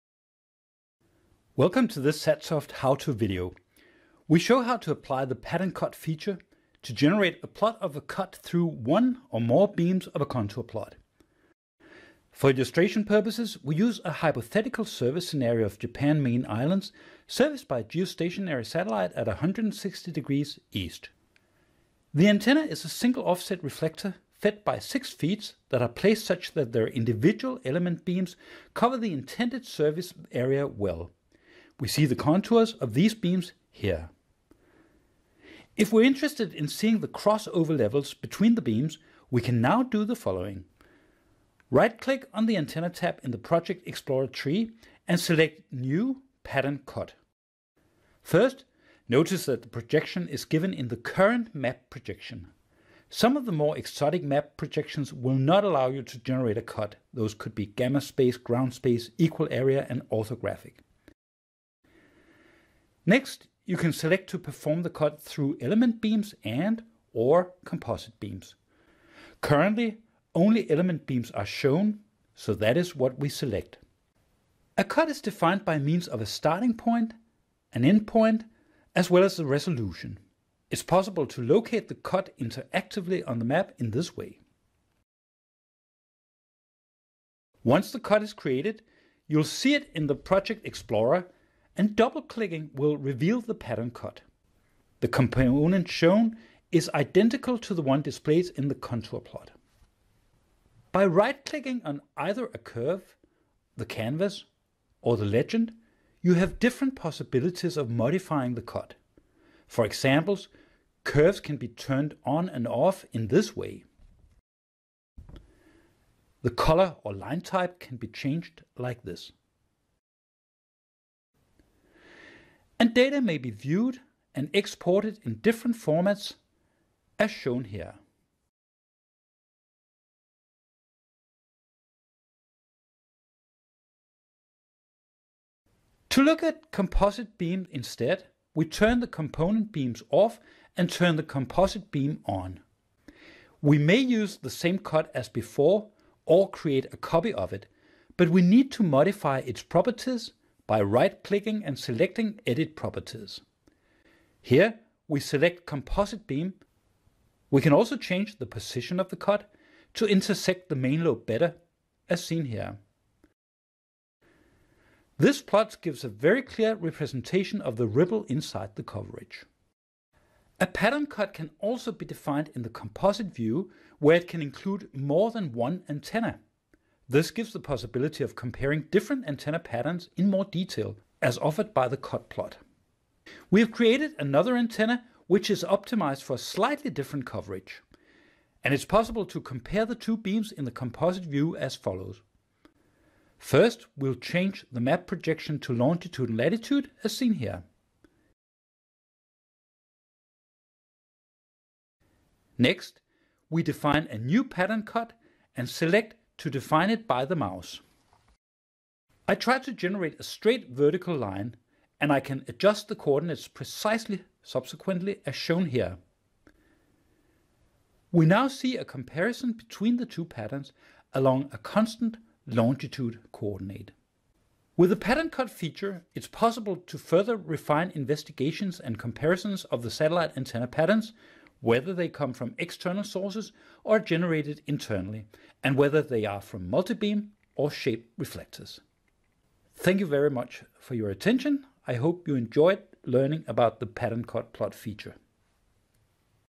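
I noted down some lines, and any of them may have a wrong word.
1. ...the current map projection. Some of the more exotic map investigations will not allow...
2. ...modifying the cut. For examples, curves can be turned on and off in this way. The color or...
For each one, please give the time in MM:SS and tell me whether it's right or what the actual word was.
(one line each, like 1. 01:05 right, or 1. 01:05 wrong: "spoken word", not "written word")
1. 00:50 wrong: "projections", not "investigations"
2. 01:47 right.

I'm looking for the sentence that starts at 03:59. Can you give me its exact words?
Thank you very much for your attention.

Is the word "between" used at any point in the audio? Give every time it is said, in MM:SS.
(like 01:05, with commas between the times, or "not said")
00:38, 03:39.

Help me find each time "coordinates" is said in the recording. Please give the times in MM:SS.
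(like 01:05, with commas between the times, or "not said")
03:32, 03:43.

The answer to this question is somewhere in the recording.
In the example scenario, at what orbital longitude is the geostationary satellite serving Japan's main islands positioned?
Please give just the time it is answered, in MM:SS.
00:19.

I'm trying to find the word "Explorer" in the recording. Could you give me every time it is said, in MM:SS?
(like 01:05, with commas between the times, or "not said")
00:43, 01:30.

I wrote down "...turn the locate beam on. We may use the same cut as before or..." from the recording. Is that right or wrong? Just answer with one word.
wrong.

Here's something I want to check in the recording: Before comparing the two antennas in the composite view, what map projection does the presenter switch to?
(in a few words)
Longitude and latitude.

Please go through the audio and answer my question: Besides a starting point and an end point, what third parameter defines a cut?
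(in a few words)
Resolution.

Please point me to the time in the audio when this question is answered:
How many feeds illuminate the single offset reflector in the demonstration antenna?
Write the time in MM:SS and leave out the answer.
00:24.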